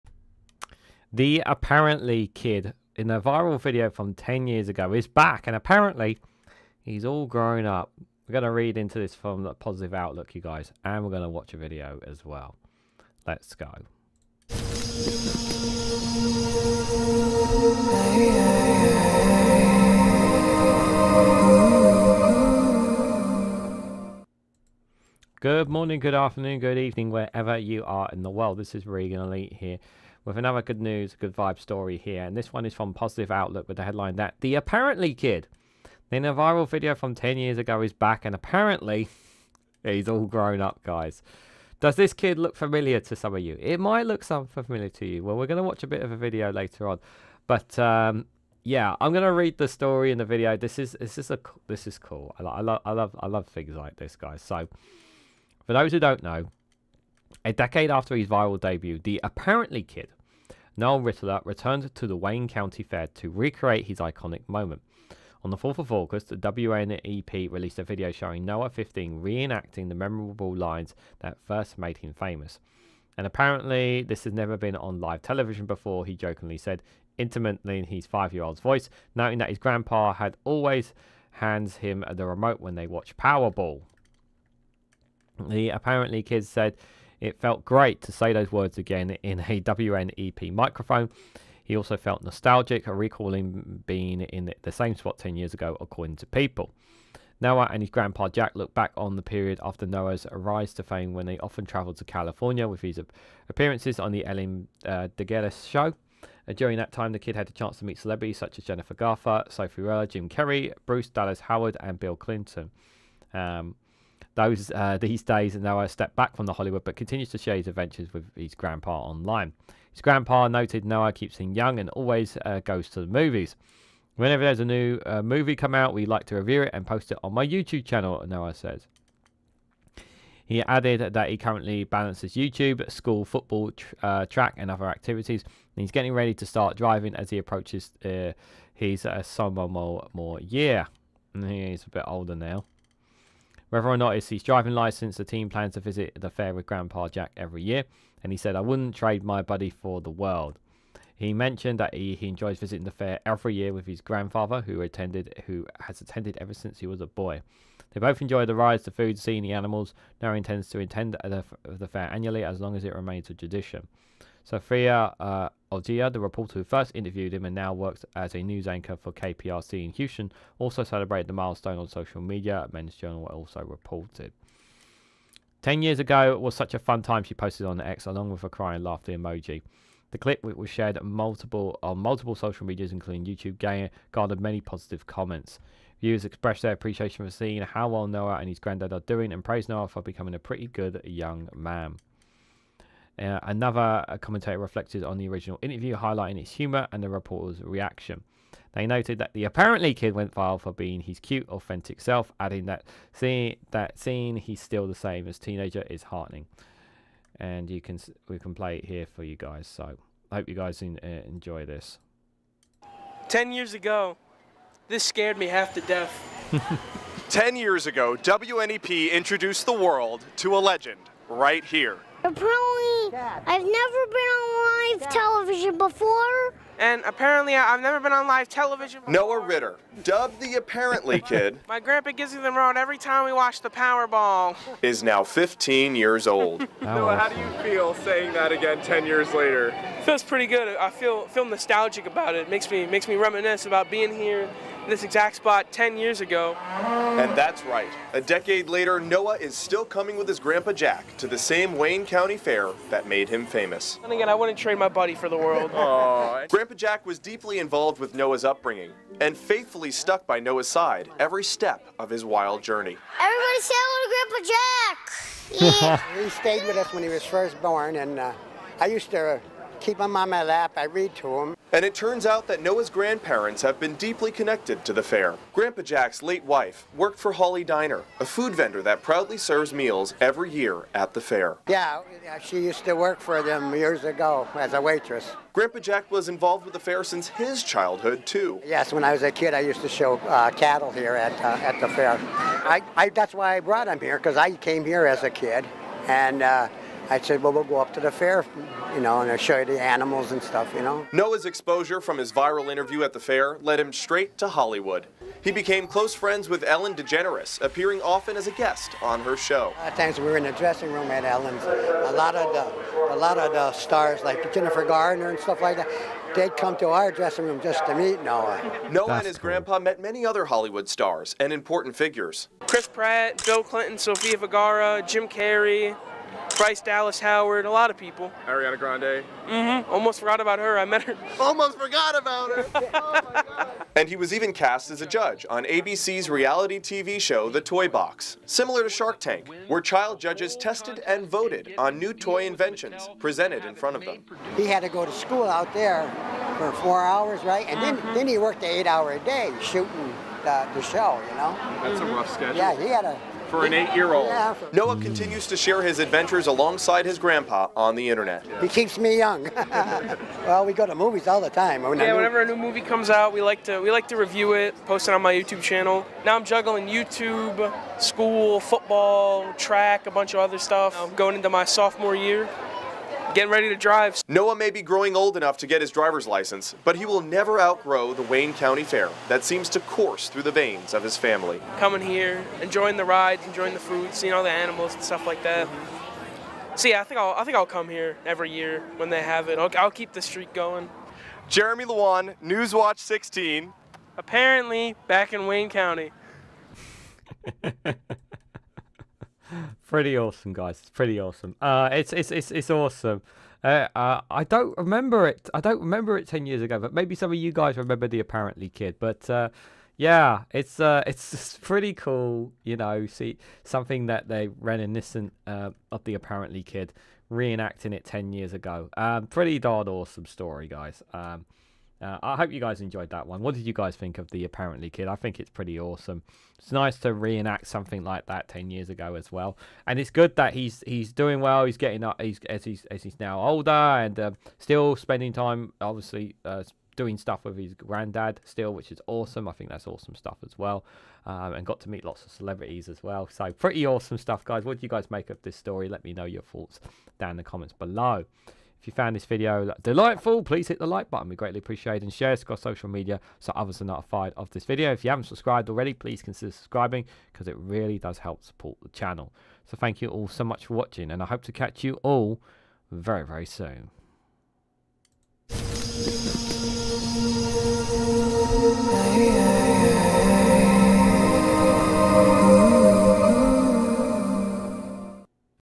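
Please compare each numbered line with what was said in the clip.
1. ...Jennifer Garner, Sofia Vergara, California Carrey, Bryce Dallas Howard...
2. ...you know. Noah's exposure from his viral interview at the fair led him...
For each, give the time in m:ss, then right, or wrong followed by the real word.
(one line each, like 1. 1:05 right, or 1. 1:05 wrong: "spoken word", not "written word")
1. 1:48 wrong: "Jim", not "California"
2. 5:00 right.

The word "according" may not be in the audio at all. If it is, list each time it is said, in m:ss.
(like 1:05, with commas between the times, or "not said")
1:35.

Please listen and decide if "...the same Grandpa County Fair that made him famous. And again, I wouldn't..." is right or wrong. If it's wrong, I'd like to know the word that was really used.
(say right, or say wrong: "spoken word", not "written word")
wrong: "Wayne", not "Grandpa".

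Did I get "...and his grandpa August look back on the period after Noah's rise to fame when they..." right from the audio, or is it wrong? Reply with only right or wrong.
wrong.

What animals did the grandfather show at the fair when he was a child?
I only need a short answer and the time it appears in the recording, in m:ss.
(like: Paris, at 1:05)
cattle, at 4:50.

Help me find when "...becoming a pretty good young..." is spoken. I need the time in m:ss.
3:10.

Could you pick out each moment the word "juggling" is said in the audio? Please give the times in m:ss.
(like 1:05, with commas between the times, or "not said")
6:06.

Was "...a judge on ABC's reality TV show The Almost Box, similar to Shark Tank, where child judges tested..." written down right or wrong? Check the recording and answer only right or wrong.
wrong.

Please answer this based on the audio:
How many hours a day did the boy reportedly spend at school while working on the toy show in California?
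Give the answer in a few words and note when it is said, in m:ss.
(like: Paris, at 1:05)
4, at 5:46.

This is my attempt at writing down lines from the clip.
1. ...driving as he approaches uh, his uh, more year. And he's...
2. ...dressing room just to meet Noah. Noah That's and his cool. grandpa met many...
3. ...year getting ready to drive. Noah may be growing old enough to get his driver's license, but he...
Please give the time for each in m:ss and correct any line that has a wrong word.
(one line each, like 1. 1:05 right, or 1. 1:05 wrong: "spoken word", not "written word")
1. 2:16 right
2. 5:17 right
3. 6:12 right.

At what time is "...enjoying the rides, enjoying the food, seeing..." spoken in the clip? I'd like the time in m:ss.
6:22.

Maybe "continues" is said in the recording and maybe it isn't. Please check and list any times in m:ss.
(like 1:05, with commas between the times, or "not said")
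1:56, 5:54.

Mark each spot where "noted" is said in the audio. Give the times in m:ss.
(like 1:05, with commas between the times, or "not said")
2:00, 3:18.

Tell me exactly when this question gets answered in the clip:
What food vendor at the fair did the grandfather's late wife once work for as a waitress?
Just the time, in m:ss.
4:37.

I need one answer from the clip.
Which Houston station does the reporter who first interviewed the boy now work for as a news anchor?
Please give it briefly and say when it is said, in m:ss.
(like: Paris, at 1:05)
KPRC, at 2:49.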